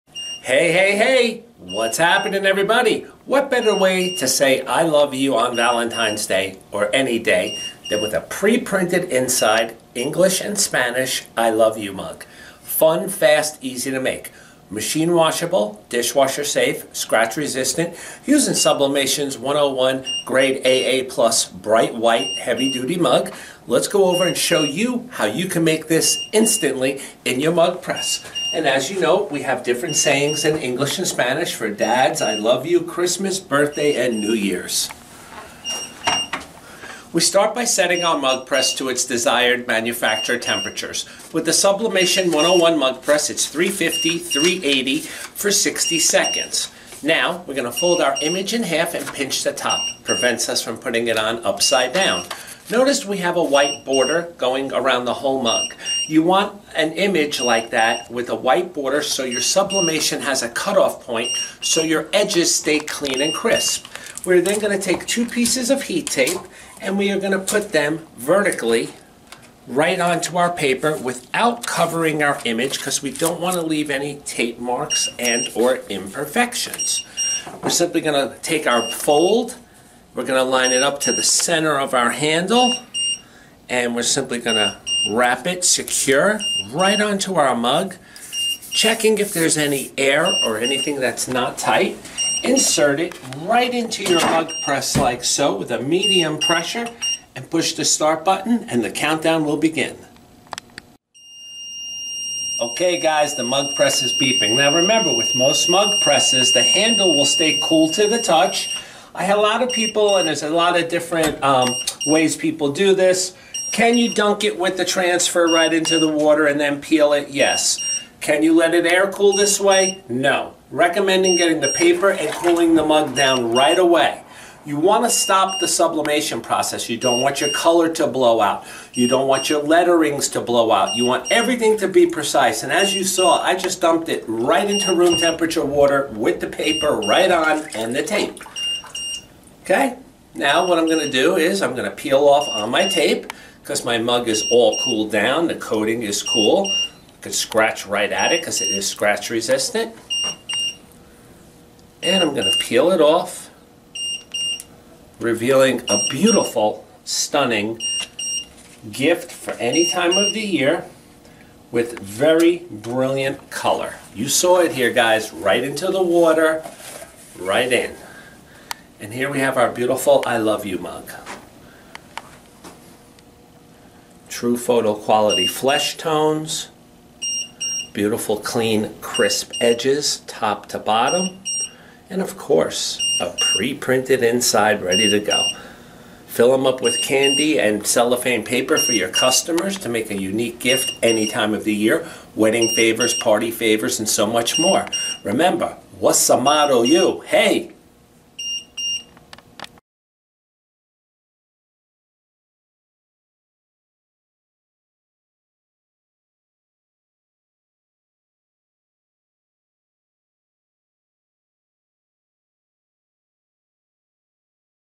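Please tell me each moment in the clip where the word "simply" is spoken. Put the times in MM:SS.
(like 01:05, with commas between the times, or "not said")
01:17, 01:24.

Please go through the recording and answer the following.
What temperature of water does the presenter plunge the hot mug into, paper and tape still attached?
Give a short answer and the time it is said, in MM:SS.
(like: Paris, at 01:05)
Room temperature, at 02:14.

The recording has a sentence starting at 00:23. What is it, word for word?
Let's go over and show you how you can make this instantly in your mug press.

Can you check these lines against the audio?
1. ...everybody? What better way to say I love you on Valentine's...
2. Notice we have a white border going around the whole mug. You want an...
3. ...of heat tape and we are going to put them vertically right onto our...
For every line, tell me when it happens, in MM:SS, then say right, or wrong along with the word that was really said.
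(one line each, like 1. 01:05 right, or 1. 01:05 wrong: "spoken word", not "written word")
1. 00:02 right
2. 00:52 right
3. 01:05 right.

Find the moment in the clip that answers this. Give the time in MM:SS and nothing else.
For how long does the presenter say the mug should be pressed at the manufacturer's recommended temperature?
00:45.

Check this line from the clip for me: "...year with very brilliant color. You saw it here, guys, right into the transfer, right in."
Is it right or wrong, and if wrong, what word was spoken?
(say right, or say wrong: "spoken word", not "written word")
wrong: "water", not "transfer".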